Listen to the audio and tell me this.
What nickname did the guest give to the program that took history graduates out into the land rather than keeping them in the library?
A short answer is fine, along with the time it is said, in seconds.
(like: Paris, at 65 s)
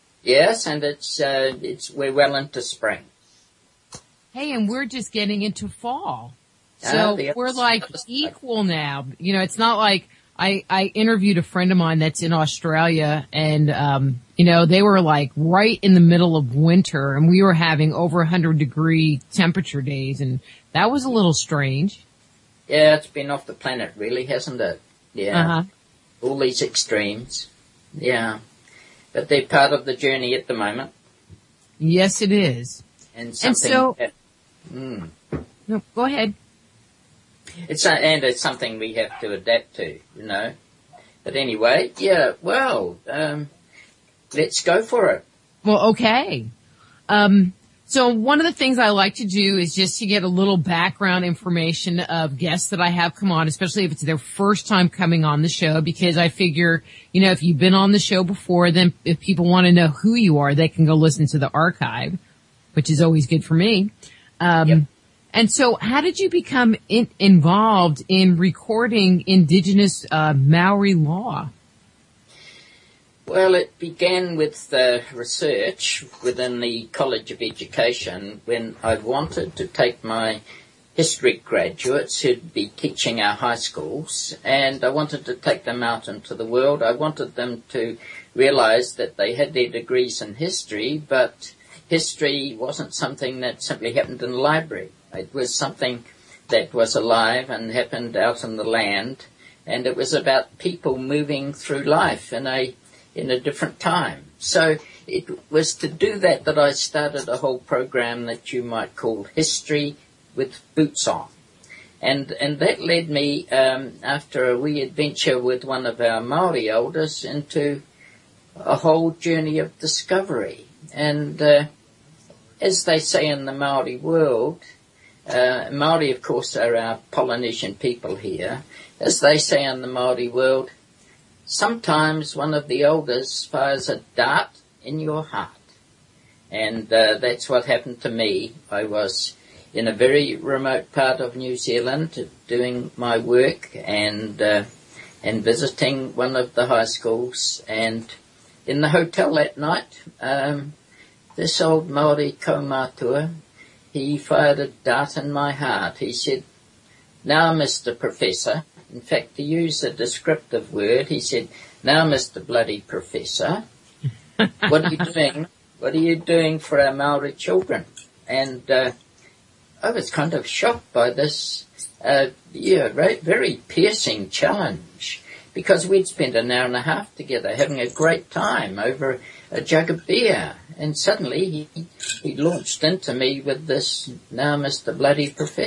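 History with Boots On, at 109 s.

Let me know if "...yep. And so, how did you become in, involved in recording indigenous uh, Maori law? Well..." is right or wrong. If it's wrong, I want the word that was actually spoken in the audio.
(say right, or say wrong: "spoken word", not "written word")
right.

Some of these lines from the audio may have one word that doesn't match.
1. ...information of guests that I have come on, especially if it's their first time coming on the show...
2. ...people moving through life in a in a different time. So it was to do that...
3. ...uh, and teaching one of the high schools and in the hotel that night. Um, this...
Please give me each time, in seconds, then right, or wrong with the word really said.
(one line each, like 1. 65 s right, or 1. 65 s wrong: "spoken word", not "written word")
1. 51 s right
2. 100 s right
3. 144 s wrong: "visiting", not "teaching".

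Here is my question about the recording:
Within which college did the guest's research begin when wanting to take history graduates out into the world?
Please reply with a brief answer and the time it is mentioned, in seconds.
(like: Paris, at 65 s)
College of Education, at 76 s.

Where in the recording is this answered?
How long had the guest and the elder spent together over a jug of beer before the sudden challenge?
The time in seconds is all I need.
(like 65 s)
176 s.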